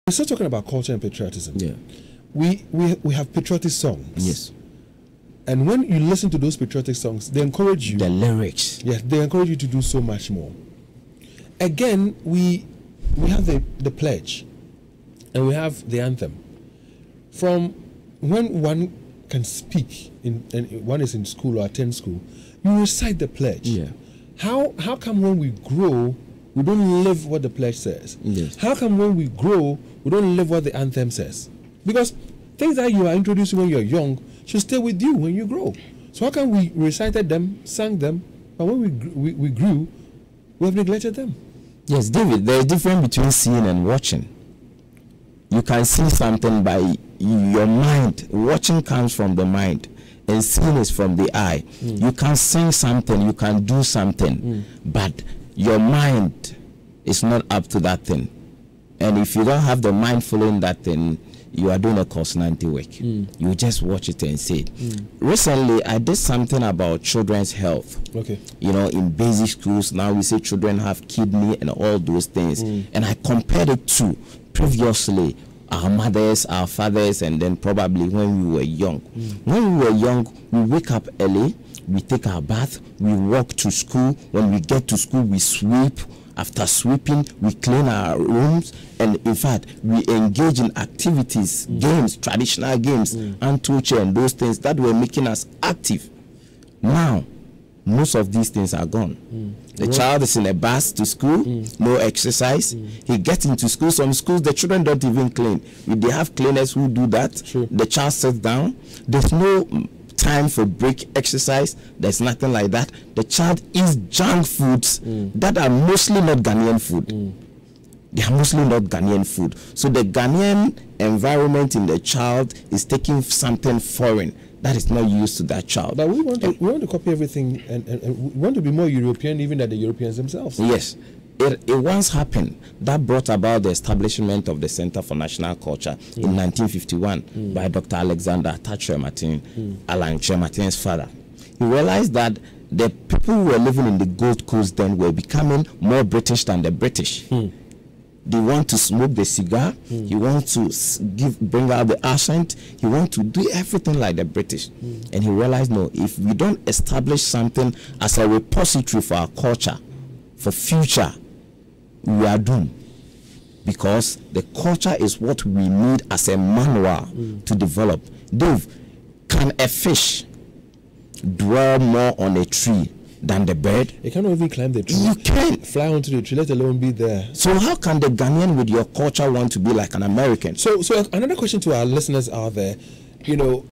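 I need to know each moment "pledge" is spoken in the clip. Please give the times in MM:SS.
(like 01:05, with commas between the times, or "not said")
00:13, 00:23, 00:27.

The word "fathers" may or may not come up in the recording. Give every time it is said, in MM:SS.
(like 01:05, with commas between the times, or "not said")
01:16, 02:20.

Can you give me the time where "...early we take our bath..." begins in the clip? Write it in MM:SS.
01:21.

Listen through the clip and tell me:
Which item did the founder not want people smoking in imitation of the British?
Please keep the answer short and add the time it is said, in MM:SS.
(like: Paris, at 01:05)
cigar, at 02:29.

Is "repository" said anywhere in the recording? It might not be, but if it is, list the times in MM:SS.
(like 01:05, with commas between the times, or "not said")
02:38.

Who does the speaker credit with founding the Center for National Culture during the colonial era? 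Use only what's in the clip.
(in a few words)
Dr. Alexander Atta Kyerematen.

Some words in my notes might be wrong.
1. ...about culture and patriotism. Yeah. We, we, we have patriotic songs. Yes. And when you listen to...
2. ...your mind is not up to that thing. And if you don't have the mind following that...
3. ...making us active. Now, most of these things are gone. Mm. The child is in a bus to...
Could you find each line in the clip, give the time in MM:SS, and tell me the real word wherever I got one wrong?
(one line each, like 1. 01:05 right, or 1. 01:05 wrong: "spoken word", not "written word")
1. 00:00 right
2. 00:55 right
3. 01:34 right.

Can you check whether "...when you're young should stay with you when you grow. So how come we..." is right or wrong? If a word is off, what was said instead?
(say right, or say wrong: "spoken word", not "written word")
right.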